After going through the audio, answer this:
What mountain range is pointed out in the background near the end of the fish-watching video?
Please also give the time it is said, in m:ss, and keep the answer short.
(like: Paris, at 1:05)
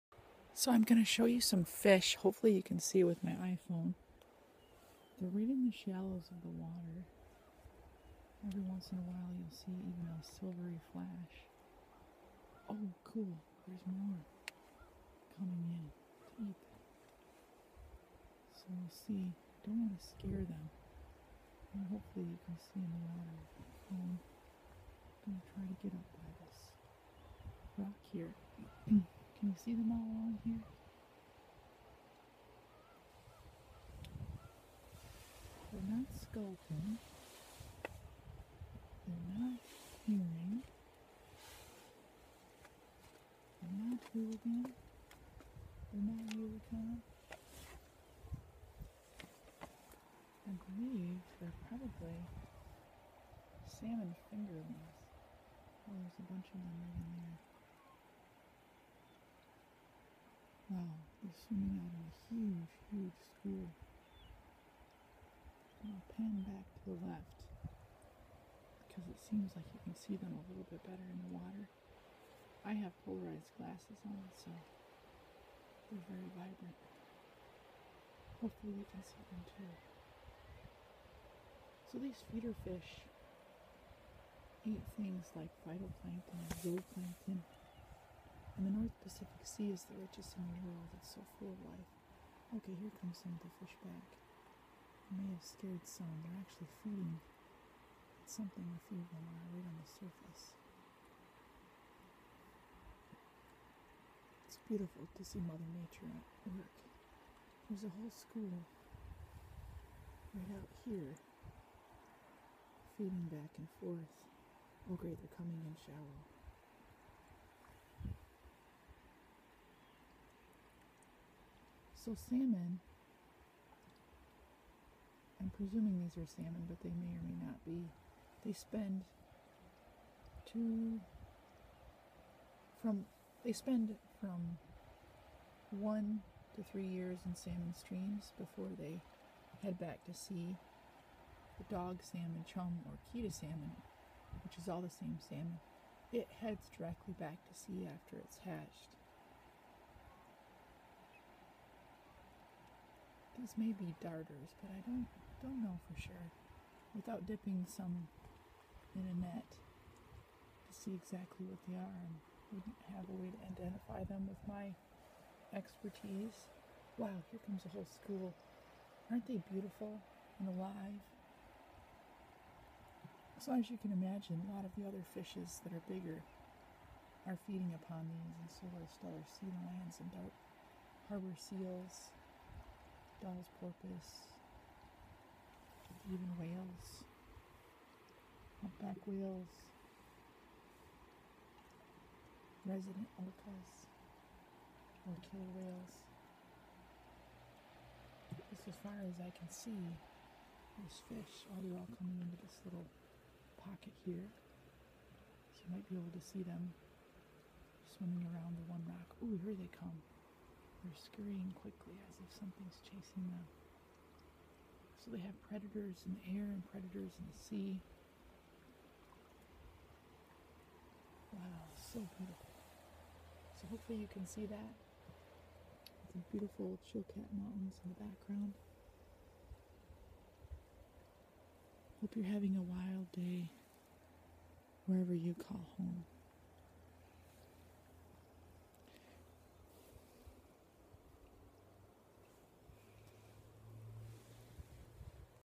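Chilkat Mountains, at 3:46.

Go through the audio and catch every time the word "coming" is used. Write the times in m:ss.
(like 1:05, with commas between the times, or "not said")
0:15, 1:55, 3:22.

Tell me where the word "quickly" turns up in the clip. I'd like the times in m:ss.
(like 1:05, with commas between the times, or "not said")
3:31.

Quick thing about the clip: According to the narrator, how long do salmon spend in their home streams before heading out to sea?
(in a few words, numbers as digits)
1 to 3 years.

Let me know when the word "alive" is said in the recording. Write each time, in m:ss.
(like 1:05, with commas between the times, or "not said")
2:50.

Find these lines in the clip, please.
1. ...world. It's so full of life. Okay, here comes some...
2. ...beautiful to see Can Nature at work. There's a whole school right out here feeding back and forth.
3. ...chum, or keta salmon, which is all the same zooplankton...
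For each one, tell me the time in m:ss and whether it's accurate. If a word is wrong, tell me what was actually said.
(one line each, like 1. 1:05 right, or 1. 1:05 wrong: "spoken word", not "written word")
1. 1:30 right
2. 1:44 wrong: "Mother", not "Can"
3. 2:22 wrong: "salmon", not "zooplankton".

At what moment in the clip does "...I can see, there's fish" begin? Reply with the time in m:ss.
3:19.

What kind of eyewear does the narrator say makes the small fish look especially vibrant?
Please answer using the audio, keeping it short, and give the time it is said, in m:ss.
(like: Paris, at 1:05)
polarized glasses, at 1:13.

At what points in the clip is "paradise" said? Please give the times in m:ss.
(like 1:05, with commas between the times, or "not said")
not said.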